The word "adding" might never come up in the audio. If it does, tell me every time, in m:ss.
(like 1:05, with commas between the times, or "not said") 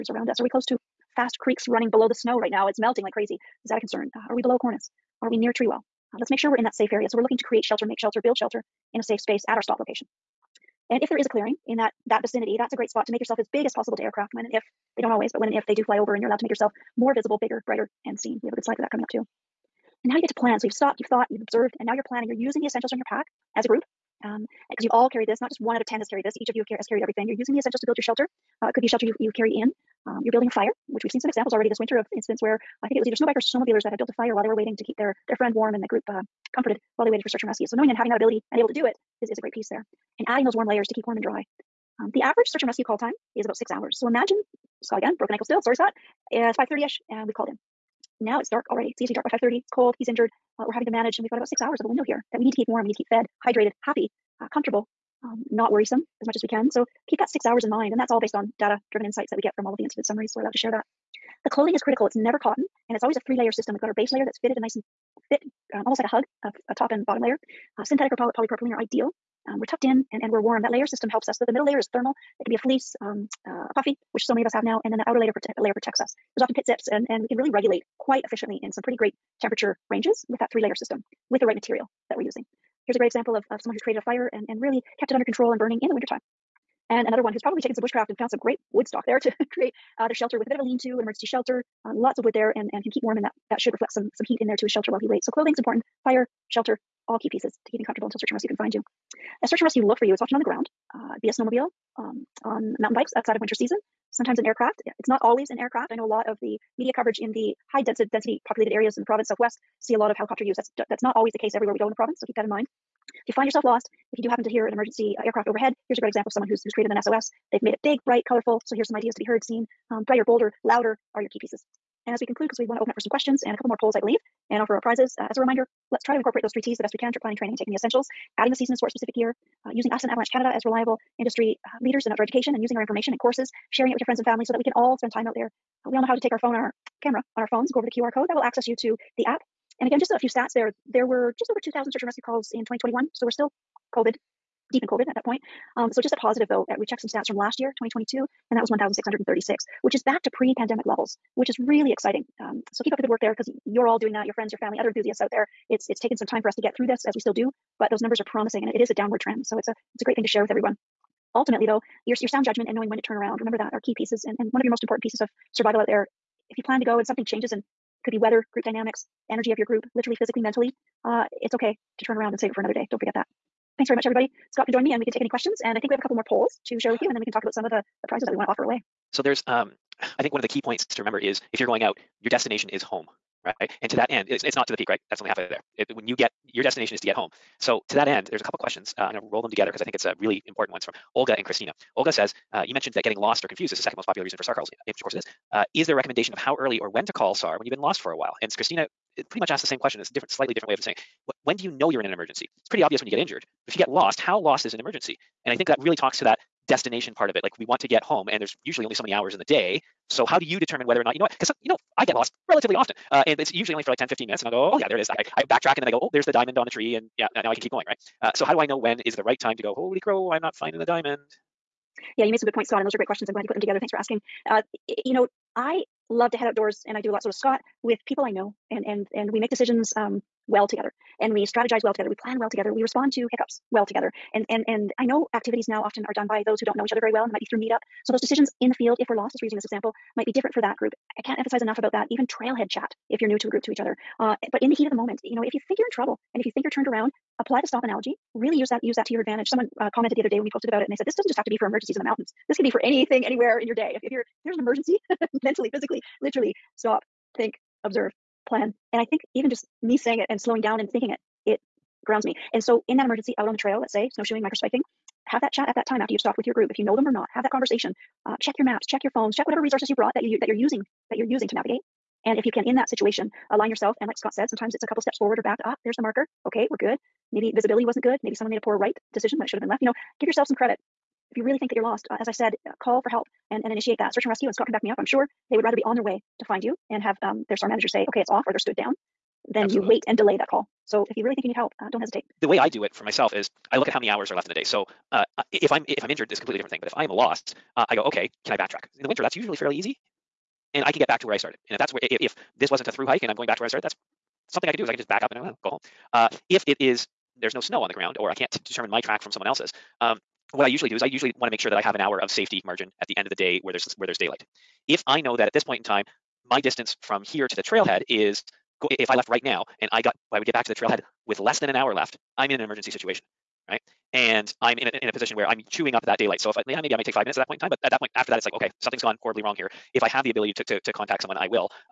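0:40, 2:08.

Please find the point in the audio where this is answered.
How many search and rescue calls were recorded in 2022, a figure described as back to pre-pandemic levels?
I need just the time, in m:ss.
2:28.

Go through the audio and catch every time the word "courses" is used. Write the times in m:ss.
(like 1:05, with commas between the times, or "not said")
2:13, 3:15.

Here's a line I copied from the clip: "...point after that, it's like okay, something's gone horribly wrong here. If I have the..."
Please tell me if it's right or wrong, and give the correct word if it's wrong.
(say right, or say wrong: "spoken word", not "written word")
right.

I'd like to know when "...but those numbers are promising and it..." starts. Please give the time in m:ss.
2:37.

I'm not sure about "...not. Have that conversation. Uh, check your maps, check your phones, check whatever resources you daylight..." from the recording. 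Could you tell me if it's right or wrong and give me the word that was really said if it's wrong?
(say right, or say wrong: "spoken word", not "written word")
wrong: "brought", not "daylight".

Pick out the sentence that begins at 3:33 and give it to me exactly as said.
Uh, and it's usually only for like 10, 15 minutes.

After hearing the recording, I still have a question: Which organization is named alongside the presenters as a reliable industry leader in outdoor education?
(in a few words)
Avalanche Canada.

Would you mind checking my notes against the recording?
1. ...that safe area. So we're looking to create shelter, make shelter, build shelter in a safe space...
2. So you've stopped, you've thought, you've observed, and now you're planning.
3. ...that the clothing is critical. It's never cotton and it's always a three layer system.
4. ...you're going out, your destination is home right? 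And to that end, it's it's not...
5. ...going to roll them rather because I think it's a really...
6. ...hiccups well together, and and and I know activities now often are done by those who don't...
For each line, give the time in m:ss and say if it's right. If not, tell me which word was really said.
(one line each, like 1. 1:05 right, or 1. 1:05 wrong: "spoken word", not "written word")
1. 0:06 right
2. 0:20 right
3. 1:00 right
4. 3:01 right
5. 3:09 wrong: "together", not "rather"
6. 3:53 right.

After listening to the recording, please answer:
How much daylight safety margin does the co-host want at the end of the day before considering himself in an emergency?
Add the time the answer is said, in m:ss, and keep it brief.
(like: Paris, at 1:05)
1 hour, at 5:11.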